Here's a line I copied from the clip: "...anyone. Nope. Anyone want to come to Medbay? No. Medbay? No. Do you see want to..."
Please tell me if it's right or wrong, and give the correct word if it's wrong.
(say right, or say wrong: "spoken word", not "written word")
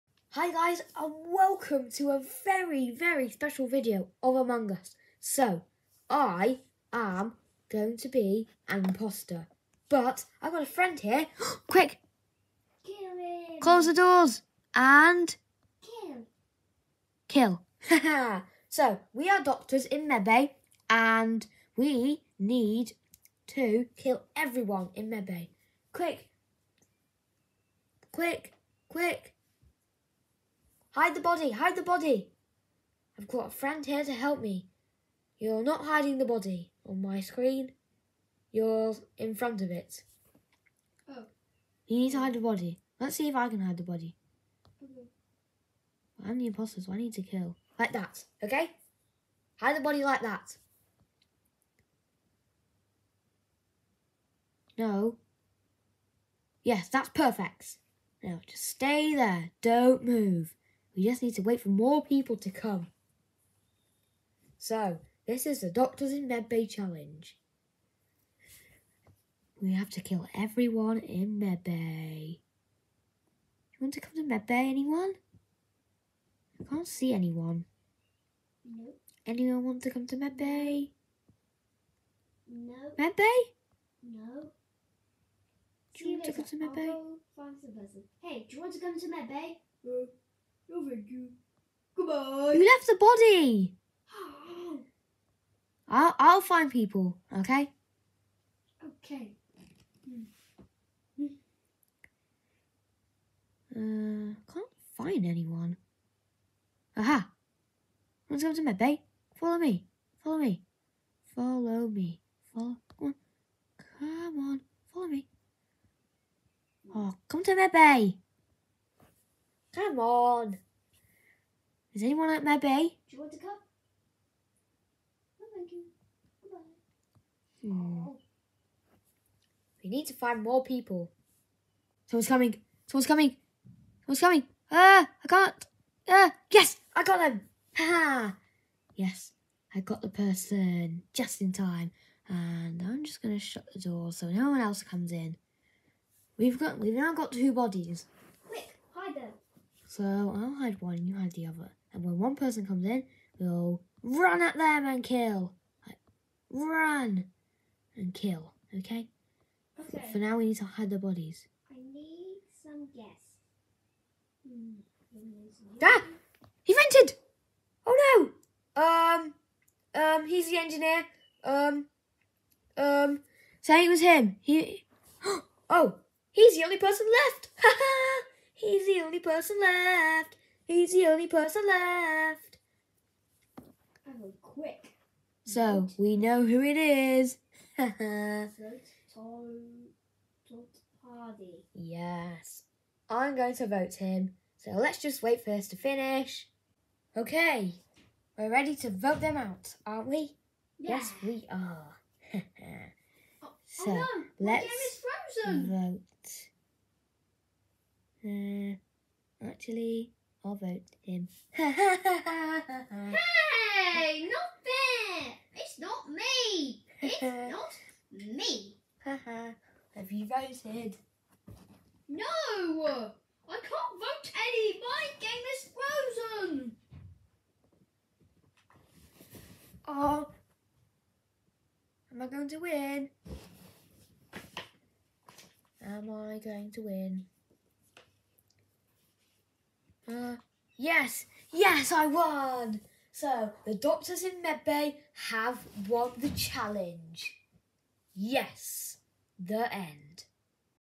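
right.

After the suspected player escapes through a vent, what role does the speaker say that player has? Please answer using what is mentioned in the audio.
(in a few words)
Engineer.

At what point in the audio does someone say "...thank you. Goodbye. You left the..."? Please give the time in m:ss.
1:30.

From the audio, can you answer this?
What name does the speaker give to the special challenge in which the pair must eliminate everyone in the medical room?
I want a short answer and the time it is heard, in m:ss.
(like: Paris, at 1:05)
Doctors in Medbay challenge, at 1:05.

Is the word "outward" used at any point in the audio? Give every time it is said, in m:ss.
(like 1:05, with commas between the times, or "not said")
not said.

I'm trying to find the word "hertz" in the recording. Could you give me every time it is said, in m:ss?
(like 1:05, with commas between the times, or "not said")
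not said.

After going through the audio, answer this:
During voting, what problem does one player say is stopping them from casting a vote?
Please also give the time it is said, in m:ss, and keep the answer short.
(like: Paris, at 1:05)
Game is frozen, at 3:44.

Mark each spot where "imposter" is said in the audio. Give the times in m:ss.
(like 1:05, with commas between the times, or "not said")
0:08, 0:46.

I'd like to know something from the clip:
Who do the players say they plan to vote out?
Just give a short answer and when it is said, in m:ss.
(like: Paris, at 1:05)
Tom Hardy, at 3:07.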